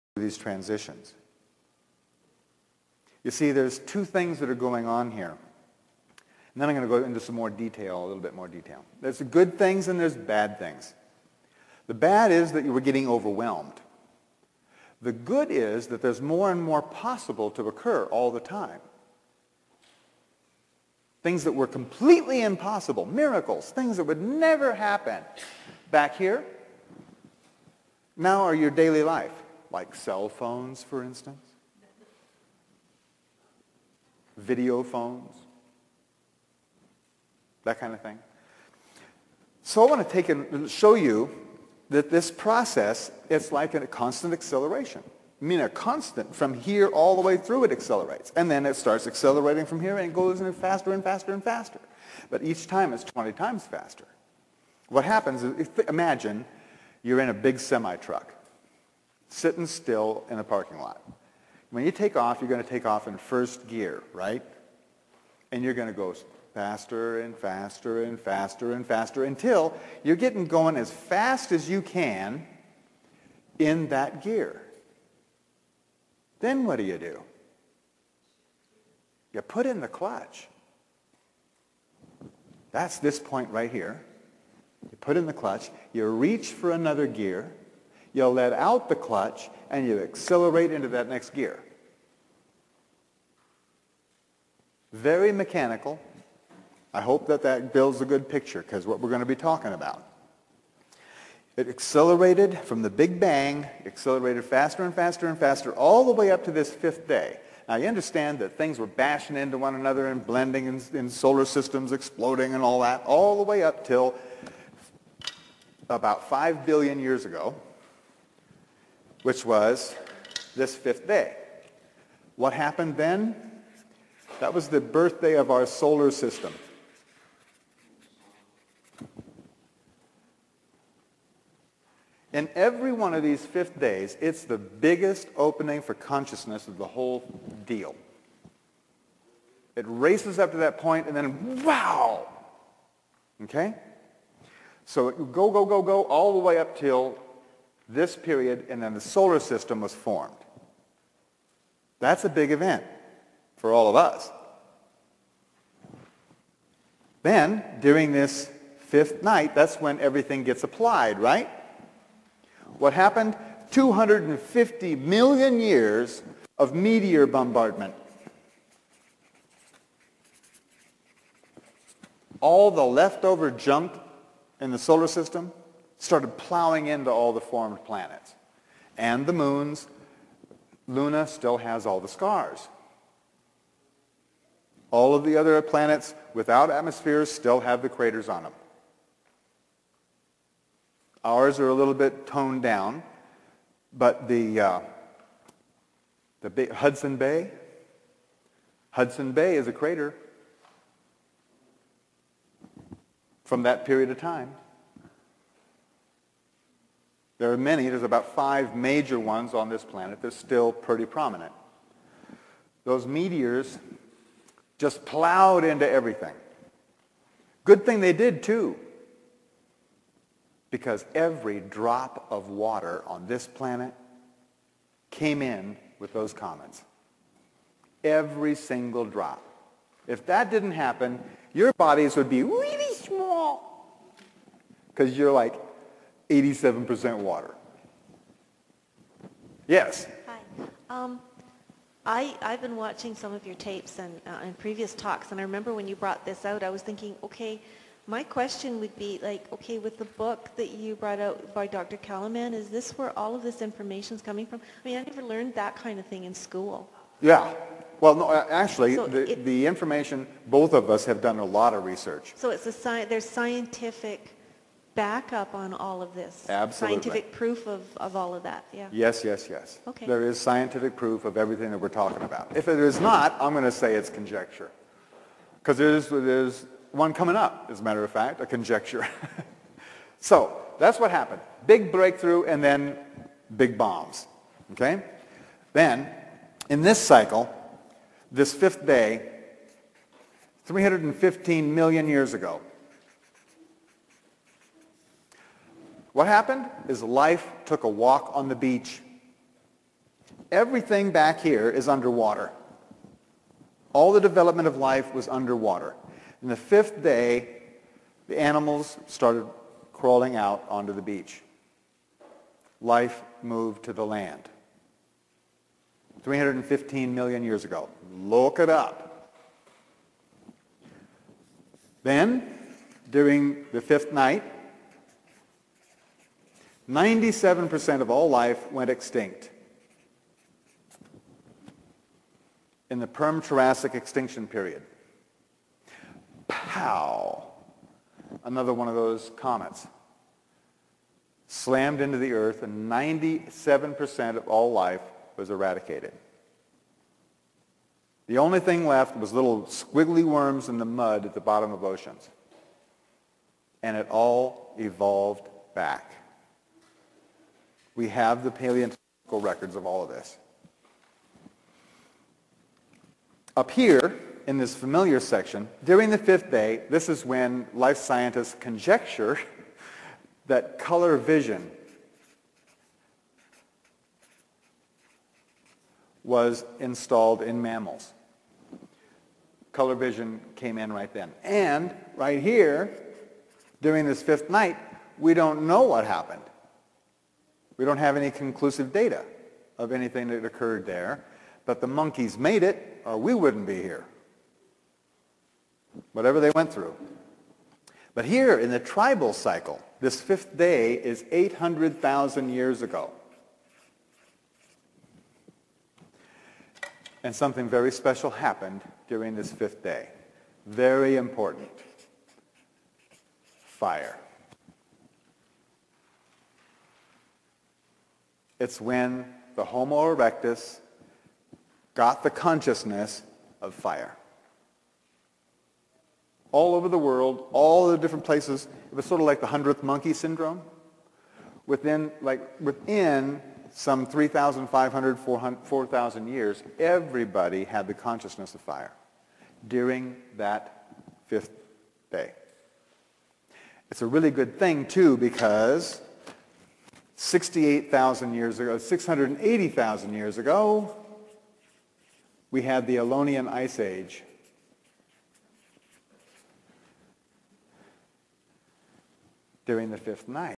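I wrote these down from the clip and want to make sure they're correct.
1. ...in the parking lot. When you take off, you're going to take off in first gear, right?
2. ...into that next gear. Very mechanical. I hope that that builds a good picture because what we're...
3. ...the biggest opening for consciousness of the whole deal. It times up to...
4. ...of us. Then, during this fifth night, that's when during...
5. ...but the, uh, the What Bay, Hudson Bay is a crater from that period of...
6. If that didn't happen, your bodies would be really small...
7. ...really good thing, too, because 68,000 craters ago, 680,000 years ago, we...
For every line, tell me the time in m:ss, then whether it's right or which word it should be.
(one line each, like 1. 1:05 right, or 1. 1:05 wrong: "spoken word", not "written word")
1. 1:00 right
2. 1:30 right
3. 2:14 wrong: "races", not "times"
4. 2:33 wrong: "everything", not "during"
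5. 3:13 wrong: "Hudson", not "What"
6. 3:50 right
7. 7:24 wrong: "years", not "craters".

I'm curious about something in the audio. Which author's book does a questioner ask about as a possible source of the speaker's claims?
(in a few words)
Dr. Calleman.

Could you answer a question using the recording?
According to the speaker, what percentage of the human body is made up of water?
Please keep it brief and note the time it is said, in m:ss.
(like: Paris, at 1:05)
87%, at 3:56.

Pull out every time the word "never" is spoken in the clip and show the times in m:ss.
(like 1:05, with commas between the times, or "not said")
0:24, 4:15.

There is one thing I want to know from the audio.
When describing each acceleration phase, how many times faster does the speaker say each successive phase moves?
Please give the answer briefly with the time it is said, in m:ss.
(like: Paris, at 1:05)
20 times, at 0:53.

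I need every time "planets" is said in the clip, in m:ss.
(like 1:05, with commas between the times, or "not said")
2:57, 3:05, 3:29, 3:43.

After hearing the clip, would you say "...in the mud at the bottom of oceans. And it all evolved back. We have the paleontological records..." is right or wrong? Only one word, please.
right.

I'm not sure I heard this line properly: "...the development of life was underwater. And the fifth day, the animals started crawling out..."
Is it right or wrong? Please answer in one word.
right.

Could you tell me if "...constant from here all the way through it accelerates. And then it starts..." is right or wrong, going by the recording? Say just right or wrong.
right.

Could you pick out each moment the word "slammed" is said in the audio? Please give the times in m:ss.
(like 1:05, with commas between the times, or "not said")
5:41.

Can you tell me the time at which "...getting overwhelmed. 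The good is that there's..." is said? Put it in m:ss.
0:12.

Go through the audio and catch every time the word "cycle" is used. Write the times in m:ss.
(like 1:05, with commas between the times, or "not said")
4:46, 6:39.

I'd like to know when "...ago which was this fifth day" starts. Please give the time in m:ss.
1:57.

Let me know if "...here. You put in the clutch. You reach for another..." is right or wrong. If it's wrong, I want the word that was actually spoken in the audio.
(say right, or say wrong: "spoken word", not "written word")
right.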